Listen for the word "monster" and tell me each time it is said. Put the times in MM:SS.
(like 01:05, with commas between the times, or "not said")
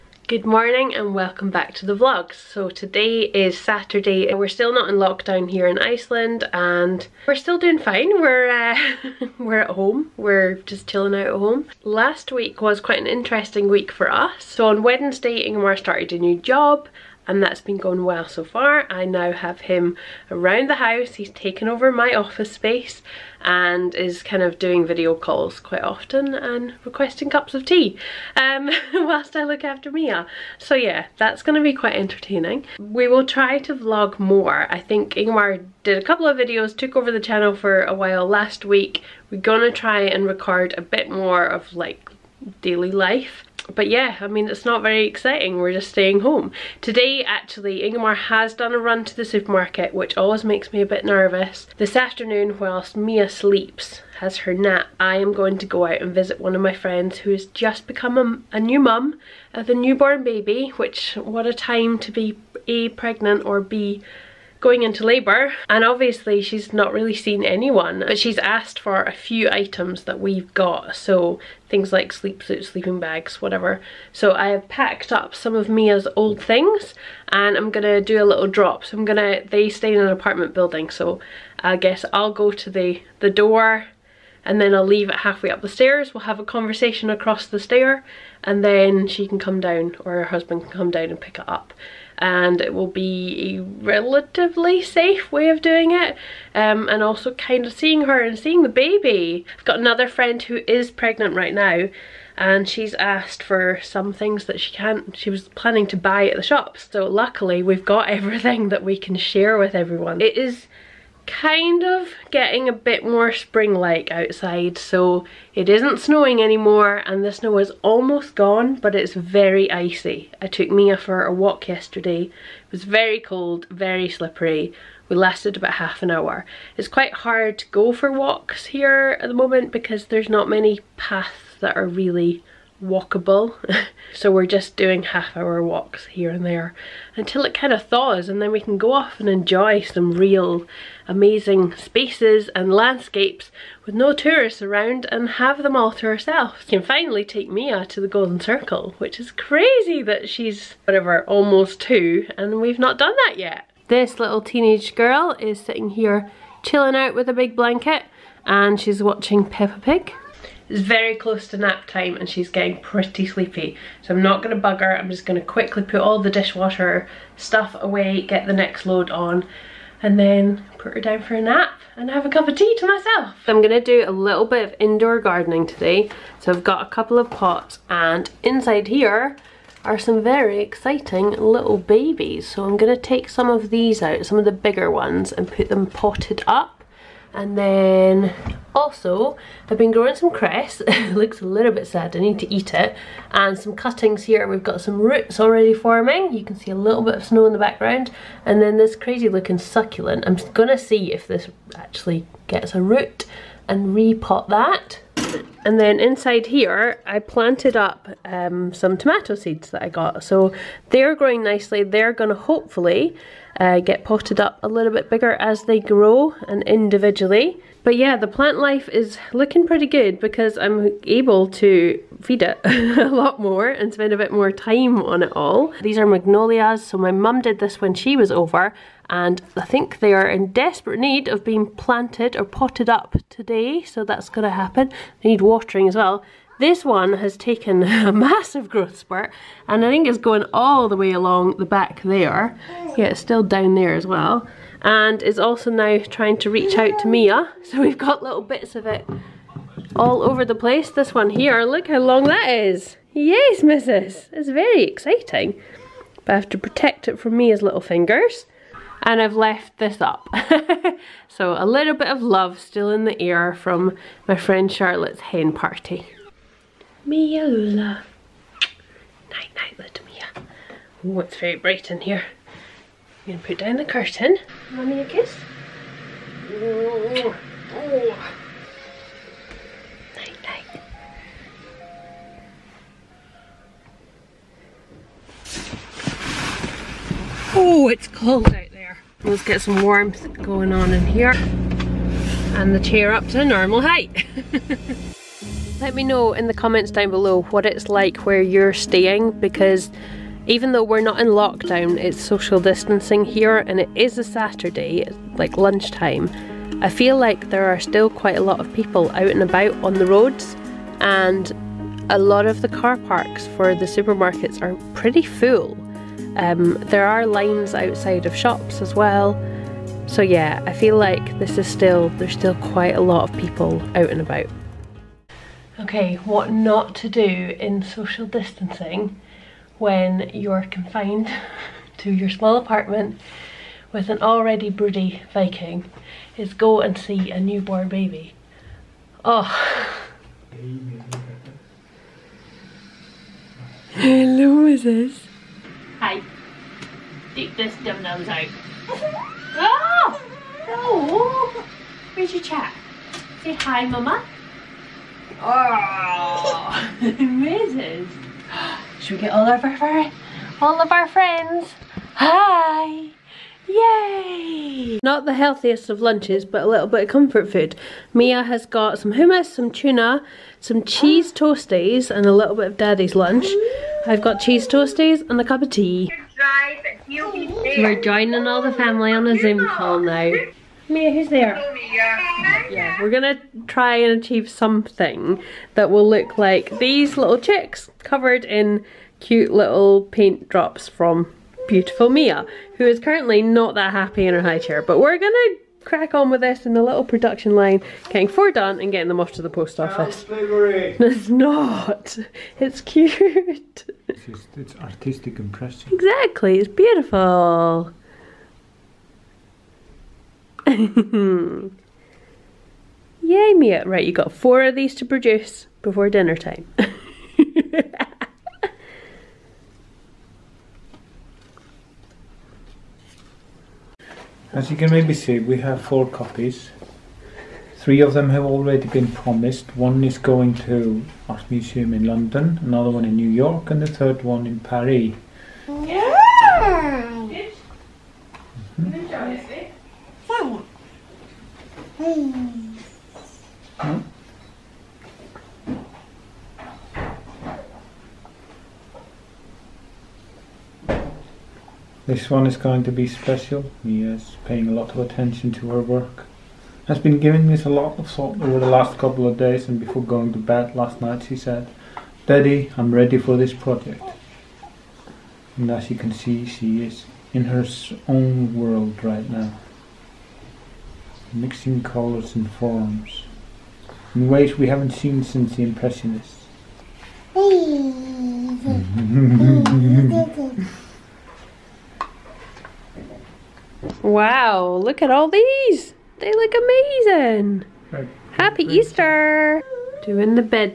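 not said.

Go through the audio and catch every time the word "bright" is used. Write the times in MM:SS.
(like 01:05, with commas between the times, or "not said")
04:31.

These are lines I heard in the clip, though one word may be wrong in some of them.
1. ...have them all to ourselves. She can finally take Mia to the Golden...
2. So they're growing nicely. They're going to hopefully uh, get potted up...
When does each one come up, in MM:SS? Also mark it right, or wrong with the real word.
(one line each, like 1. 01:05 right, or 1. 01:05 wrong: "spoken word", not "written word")
1. 02:25 right
2. 03:30 right.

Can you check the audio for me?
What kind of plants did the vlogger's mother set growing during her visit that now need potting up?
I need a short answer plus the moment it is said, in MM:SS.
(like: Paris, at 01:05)
magnolias, at 03:46.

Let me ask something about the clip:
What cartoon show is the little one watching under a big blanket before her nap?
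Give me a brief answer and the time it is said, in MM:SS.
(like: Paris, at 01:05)
Peppa Pig, at 02:39.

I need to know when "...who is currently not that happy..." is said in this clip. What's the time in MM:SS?
06:32.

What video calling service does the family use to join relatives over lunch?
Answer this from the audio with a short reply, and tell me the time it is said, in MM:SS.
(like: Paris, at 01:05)
Zoom, at 06:19.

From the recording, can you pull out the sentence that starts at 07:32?
This one is going to be special.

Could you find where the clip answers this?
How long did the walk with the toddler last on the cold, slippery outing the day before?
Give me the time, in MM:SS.
02:05.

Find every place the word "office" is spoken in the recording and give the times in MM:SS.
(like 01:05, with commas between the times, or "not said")
00:22, 06:39.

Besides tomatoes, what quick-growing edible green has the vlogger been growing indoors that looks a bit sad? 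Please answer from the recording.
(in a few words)
cress.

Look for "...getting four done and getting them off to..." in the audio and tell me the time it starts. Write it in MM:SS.
06:38.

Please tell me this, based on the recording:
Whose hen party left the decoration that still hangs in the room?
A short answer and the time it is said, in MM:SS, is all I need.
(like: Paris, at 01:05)
Charlotte, at 04:24.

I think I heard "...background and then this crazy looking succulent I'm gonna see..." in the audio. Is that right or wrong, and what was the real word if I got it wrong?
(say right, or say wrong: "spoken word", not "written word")
right.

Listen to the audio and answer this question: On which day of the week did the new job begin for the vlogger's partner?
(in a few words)
Wednesday.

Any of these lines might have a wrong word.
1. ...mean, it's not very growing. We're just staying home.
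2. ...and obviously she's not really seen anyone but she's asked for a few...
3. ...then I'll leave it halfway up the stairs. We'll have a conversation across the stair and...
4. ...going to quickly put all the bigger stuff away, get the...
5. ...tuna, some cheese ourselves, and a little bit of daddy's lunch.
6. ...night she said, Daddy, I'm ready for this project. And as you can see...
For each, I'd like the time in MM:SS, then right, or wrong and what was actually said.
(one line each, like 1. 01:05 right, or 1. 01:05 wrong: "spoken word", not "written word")
1. 00:44 wrong: "exciting", not "growing"
2. 01:05 right
3. 01:24 right
4. 02:45 wrong: "dishwasher", not "bigger"
5. 06:09 wrong: "toasties", not "ourselves"
6. 07:40 right.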